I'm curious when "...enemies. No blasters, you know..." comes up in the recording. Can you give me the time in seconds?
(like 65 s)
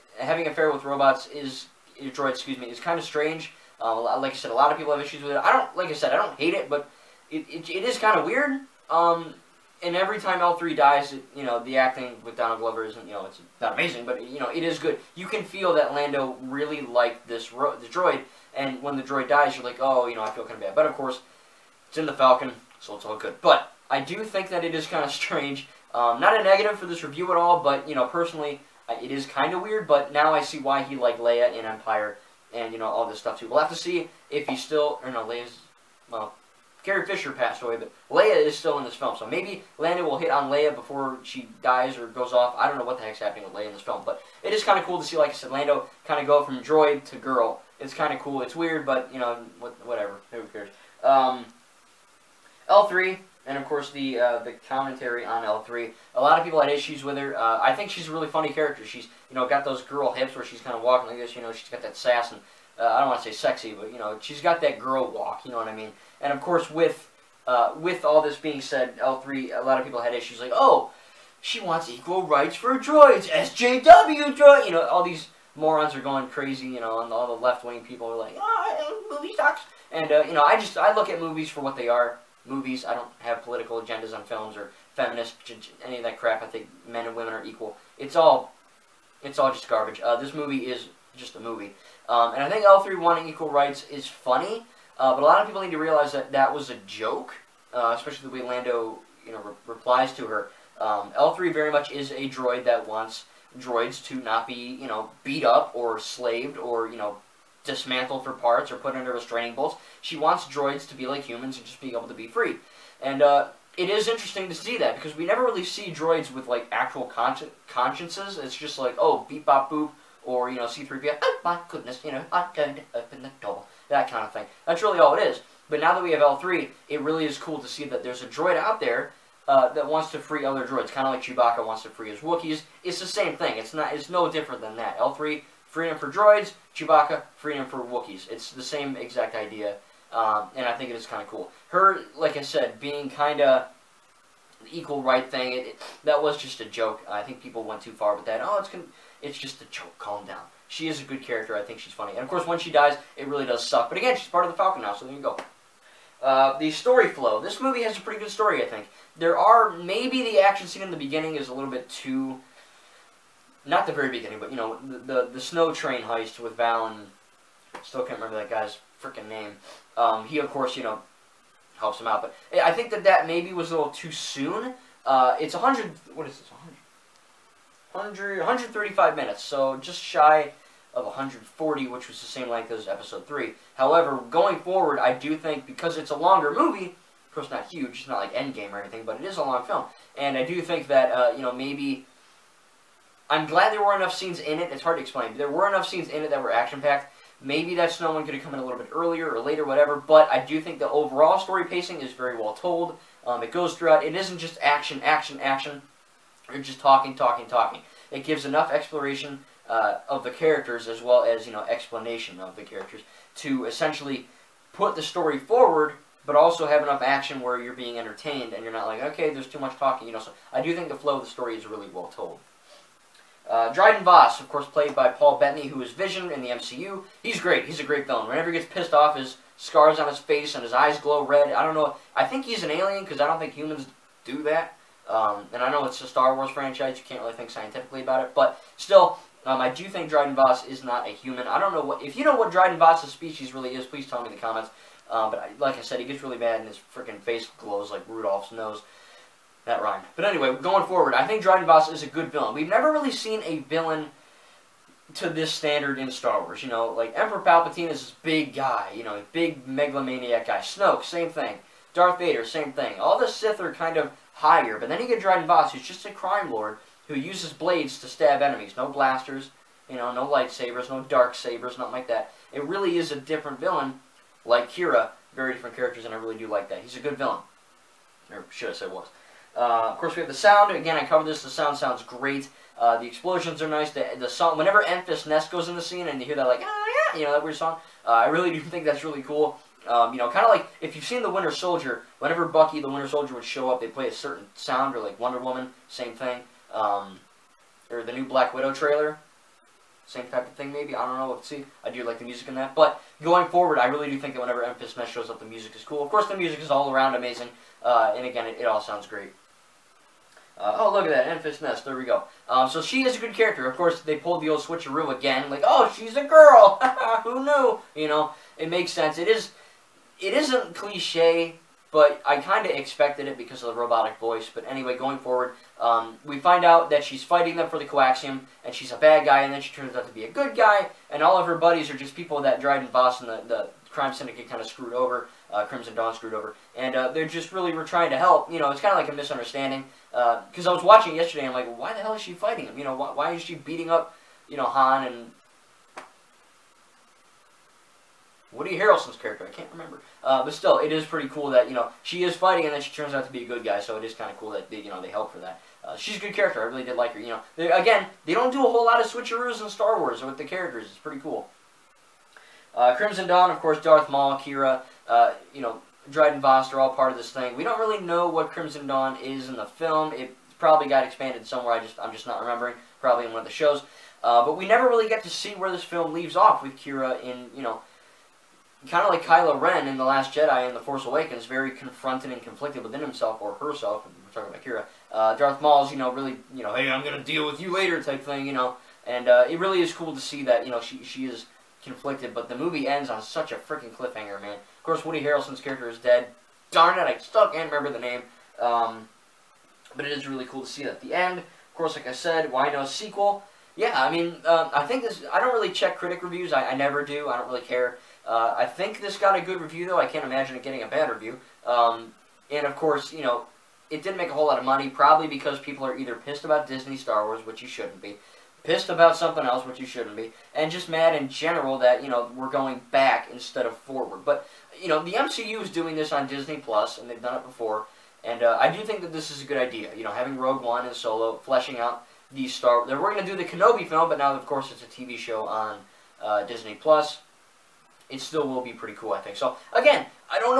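268 s.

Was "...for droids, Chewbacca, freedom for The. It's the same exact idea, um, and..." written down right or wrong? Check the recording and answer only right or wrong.
wrong.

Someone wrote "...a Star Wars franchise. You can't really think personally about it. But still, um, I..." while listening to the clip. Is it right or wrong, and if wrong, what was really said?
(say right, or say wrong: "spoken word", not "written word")
wrong: "scientifically", not "personally".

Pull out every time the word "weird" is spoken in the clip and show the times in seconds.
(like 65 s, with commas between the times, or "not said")
8 s, 29 s, 48 s, 287 s.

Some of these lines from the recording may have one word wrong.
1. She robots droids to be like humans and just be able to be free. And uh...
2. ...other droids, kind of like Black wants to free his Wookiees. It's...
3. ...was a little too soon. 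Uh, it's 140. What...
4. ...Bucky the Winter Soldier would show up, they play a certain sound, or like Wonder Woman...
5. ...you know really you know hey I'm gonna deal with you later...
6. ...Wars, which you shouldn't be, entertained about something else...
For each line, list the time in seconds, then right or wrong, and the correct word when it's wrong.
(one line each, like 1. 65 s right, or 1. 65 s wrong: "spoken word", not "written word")
1. 110 s wrong: "wants", not "robots"
2. 130 s wrong: "Chewbacca", not "Black"
3. 173 s wrong: "100", not "140"
4. 292 s right
5. 385 s right
6. 417 s wrong: "pissed", not "entertained".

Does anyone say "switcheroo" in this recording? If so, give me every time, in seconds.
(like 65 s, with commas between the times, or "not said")
314 s, 359 s.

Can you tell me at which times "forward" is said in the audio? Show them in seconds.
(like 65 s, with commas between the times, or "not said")
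184 s, 215 s, 250 s, 303 s, 325 s, 423 s.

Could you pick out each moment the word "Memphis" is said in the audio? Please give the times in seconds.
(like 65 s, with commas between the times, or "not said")
284 s, 304 s.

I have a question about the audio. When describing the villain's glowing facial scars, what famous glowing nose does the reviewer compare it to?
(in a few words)
Rudolph's nose.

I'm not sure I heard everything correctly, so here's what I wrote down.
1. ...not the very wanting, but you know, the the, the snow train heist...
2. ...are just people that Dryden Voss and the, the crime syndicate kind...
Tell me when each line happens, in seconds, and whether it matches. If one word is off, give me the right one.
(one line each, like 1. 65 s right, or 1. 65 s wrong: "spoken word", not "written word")
1. 163 s wrong: "beginning", not "wanting"
2. 331 s right.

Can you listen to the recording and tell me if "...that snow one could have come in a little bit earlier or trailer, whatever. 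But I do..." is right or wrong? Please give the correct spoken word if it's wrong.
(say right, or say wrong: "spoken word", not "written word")
wrong: "later", not "trailer".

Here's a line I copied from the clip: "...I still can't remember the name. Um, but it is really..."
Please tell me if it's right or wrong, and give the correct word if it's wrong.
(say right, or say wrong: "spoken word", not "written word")
right.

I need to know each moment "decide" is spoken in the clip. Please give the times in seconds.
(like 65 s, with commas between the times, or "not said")
not said.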